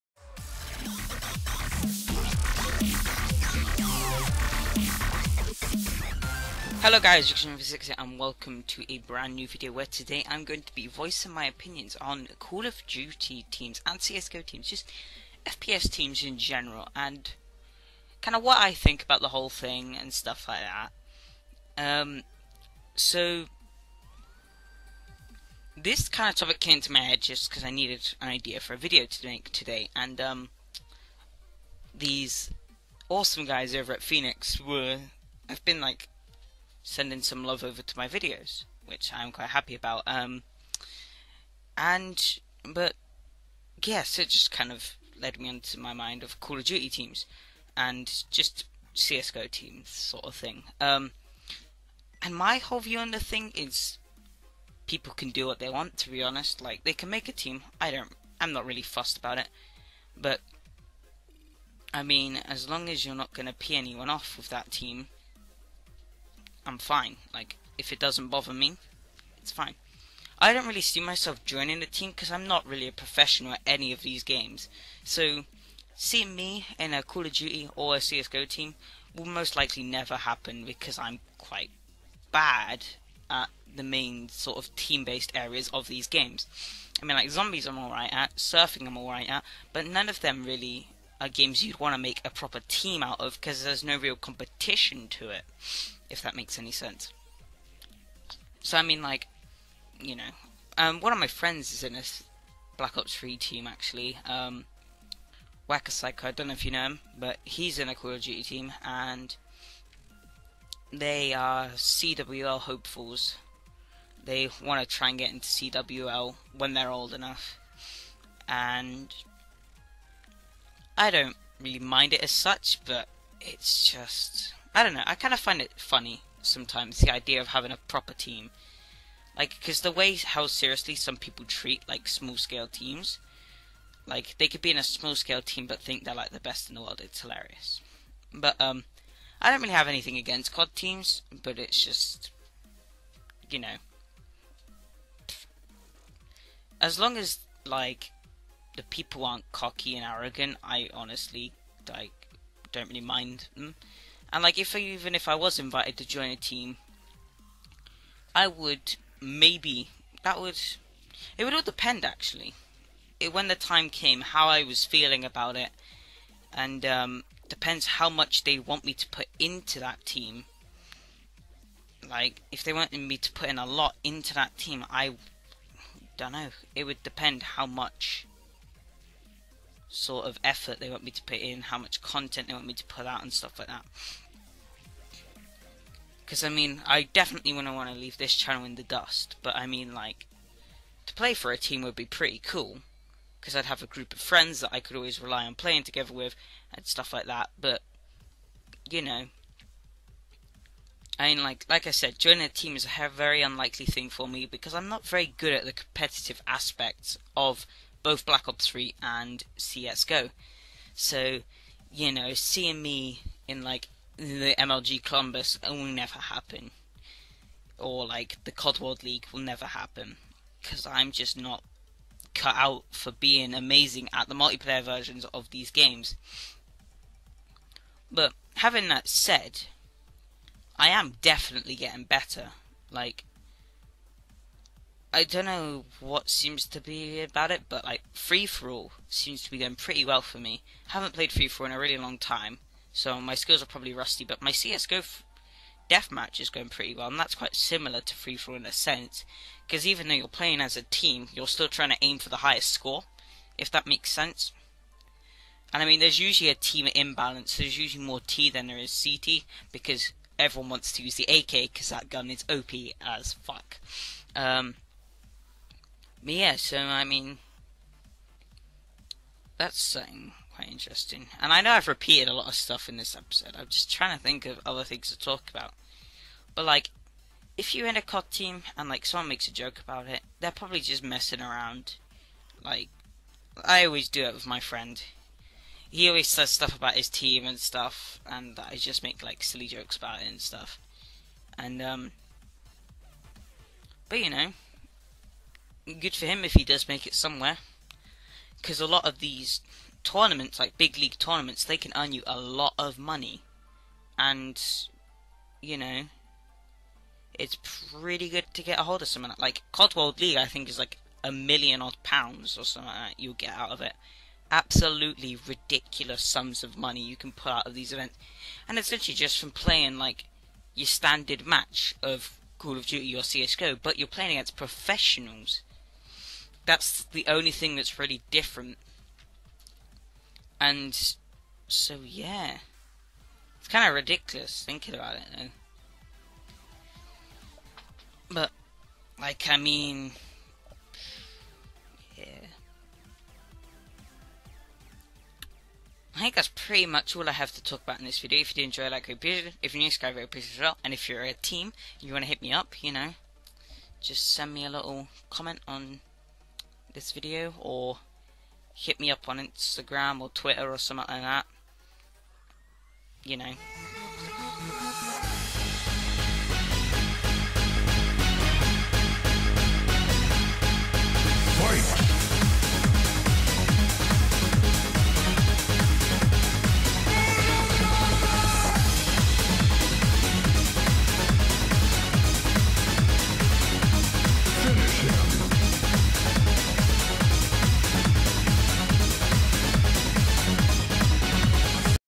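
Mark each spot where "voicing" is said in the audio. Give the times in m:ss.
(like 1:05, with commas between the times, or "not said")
0:10.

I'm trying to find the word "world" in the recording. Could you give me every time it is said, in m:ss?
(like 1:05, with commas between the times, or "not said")
2:16, 3:38, 5:09.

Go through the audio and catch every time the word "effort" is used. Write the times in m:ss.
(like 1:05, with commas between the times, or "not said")
3:00.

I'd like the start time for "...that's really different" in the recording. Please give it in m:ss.
5:27.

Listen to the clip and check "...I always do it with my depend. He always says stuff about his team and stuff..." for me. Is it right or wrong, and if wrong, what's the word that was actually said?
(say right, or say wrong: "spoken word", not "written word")
wrong: "friend", not "depend".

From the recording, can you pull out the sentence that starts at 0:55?
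To be honest, like they can make a team.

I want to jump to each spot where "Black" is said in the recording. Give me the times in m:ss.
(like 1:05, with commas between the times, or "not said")
1:42, 3:28.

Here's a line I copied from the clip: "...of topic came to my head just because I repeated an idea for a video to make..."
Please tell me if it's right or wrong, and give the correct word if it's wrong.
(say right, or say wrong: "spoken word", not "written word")
wrong: "needed", not "repeated".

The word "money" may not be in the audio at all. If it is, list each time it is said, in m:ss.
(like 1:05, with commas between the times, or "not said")
5:02, 5:16.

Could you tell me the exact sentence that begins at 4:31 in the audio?
And I know I've repeated a lot of stuff in this episode.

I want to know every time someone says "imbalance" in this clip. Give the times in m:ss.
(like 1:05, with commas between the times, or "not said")
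4:16.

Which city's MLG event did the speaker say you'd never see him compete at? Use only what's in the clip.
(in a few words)
Columbus.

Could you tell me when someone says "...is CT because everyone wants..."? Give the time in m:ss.
4:18.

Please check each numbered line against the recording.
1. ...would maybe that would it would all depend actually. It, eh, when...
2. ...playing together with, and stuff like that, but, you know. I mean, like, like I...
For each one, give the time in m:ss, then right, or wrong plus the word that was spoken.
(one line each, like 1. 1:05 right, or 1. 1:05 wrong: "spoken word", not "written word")
1. 2:38 right
2. 3:15 right.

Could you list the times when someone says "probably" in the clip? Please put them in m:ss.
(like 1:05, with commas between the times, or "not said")
4:03, 4:40.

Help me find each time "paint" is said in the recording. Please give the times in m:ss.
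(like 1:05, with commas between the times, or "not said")
not said.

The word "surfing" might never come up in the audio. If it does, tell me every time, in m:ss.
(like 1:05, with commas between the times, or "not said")
1:28.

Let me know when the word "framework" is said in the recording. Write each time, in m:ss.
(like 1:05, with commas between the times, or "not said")
not said.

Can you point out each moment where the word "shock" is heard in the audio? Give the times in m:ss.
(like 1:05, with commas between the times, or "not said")
not said.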